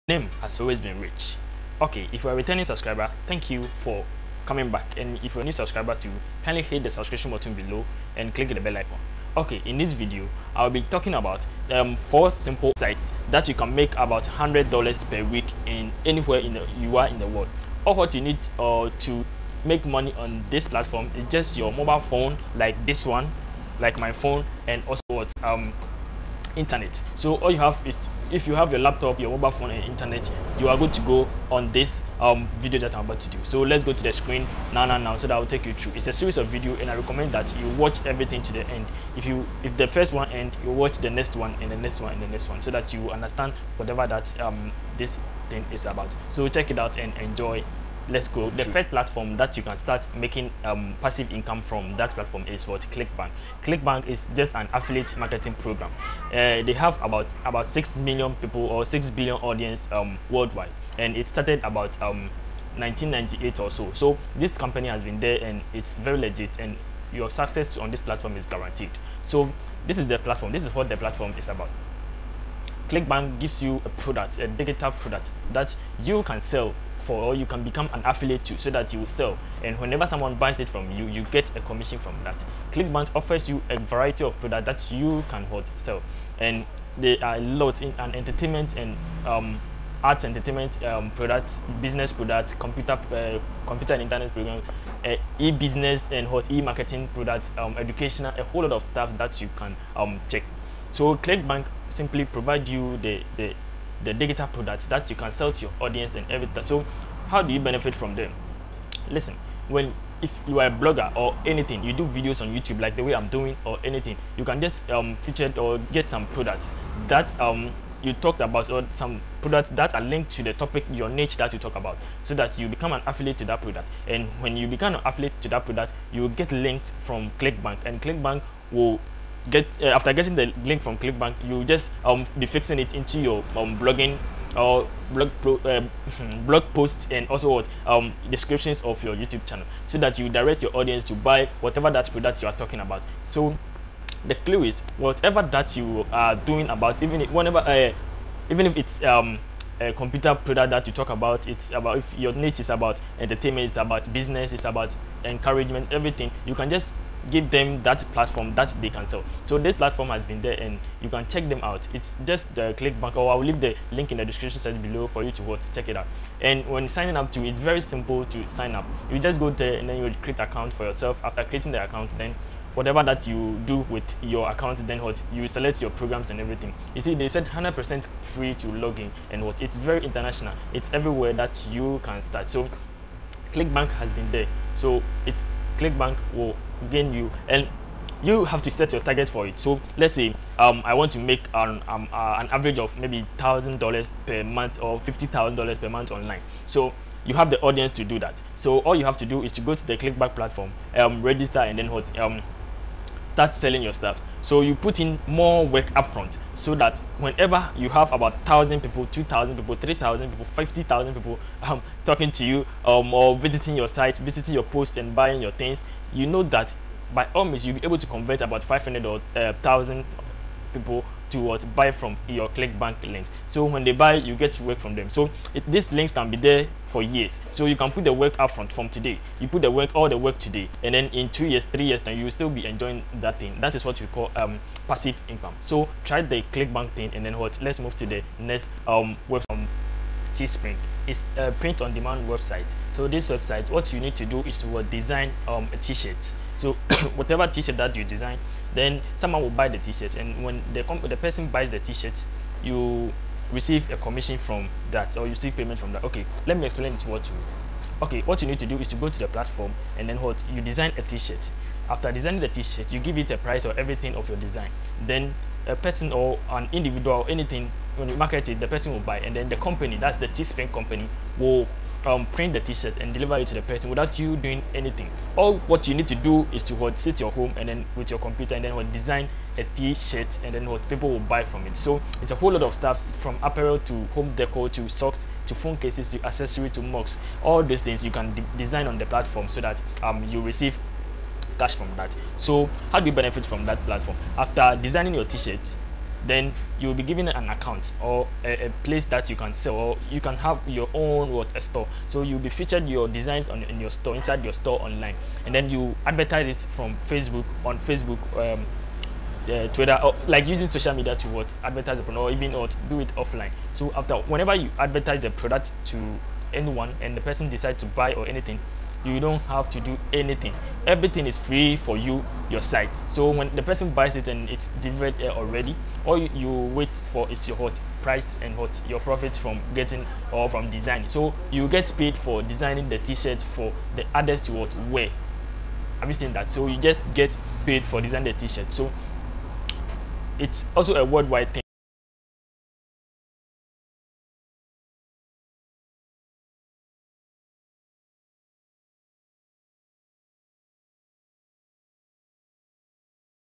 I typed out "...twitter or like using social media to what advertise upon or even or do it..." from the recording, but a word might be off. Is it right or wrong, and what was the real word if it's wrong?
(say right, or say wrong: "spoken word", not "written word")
right.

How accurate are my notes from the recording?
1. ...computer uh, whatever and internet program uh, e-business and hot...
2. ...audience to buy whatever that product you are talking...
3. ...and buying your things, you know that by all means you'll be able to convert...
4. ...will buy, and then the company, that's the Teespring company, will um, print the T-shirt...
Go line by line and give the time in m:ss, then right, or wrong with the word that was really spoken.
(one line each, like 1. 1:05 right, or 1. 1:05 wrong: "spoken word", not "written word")
1. 1:32 wrong: "computer", not "whatever"
2. 2:20 right
3. 3:34 right
4. 4:28 right.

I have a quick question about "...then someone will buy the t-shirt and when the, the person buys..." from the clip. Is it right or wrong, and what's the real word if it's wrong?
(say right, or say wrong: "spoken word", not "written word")
right.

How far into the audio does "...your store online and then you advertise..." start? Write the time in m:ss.
5:04.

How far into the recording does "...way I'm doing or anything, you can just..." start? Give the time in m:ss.
1:53.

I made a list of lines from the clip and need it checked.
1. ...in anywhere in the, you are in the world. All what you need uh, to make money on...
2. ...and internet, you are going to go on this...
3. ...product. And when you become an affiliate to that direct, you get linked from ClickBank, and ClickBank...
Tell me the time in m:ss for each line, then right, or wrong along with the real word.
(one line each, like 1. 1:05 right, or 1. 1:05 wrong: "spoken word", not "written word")
1. 0:15 right
2. 0:29 right
3. 2:03 wrong: "product", not "direct".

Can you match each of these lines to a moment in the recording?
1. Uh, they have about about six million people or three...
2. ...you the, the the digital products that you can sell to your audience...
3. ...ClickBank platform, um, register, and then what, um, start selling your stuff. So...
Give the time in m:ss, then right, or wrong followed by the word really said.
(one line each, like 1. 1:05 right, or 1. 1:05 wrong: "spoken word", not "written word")
1. 0:56 wrong: "six", not "three"
2. 1:42 right
3. 3:19 right.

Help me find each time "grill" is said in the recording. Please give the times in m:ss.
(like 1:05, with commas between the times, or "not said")
not said.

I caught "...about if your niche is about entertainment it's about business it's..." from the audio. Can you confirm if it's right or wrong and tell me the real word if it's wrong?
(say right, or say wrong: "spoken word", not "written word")
right.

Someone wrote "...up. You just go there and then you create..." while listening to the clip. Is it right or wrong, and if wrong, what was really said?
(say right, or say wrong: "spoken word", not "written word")
right.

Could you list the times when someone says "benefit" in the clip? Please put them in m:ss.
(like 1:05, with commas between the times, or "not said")
1:47, 4:53.